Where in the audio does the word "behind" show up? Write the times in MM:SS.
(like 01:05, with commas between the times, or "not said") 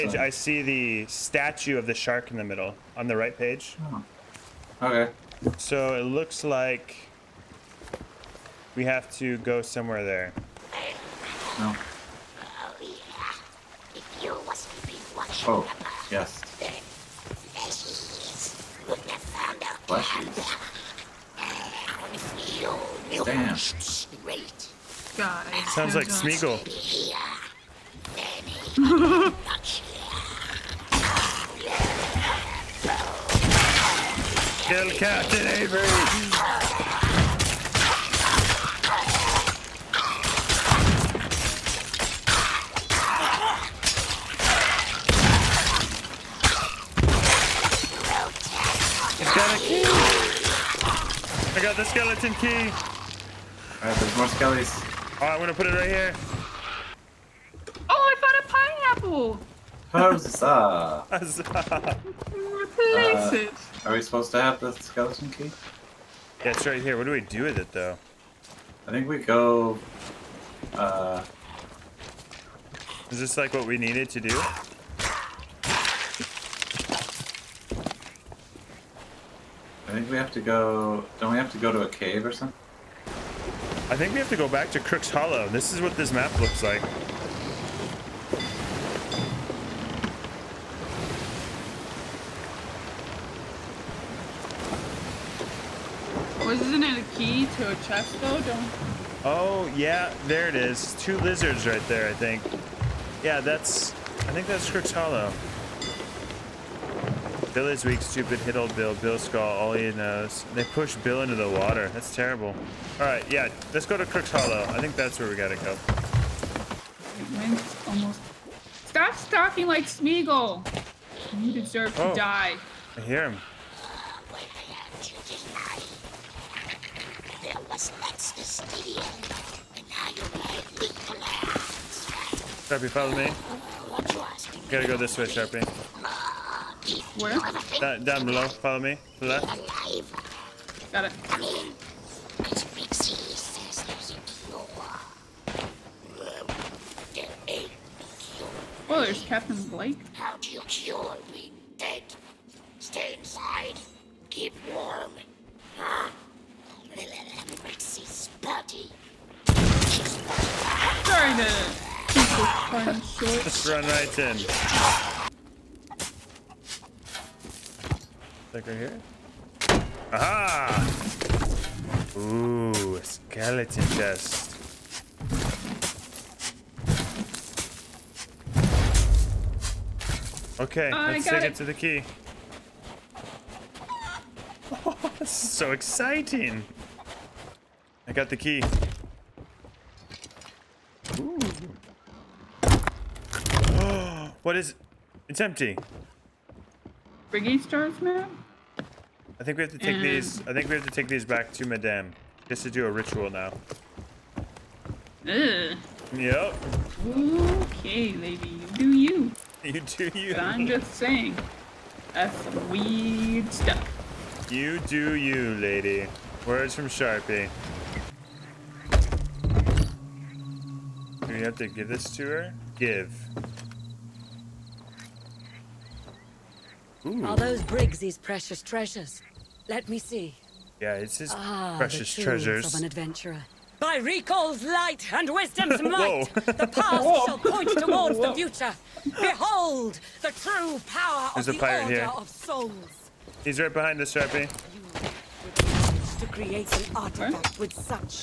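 04:03.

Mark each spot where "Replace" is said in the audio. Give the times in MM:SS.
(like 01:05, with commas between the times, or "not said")
01:01.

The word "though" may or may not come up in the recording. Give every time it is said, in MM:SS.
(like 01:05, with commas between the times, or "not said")
01:07, 01:38.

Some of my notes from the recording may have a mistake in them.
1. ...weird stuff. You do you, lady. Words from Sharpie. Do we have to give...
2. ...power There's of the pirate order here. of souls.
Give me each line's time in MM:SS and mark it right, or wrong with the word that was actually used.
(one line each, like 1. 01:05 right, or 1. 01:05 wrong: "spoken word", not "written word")
1. 03:32 right
2. 04:00 right.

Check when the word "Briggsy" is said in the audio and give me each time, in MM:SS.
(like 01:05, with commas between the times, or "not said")
03:17, 03:47.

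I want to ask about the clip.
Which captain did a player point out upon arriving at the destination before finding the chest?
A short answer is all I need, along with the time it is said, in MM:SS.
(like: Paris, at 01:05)
Captain Blake, at 02:29.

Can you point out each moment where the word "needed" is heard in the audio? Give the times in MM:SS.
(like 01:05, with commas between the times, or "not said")
01:13.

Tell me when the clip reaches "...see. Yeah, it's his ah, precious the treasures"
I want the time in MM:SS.
03:49.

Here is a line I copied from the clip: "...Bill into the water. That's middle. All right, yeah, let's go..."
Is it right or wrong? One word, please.
wrong.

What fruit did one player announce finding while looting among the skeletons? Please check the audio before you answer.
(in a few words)
Pineapple.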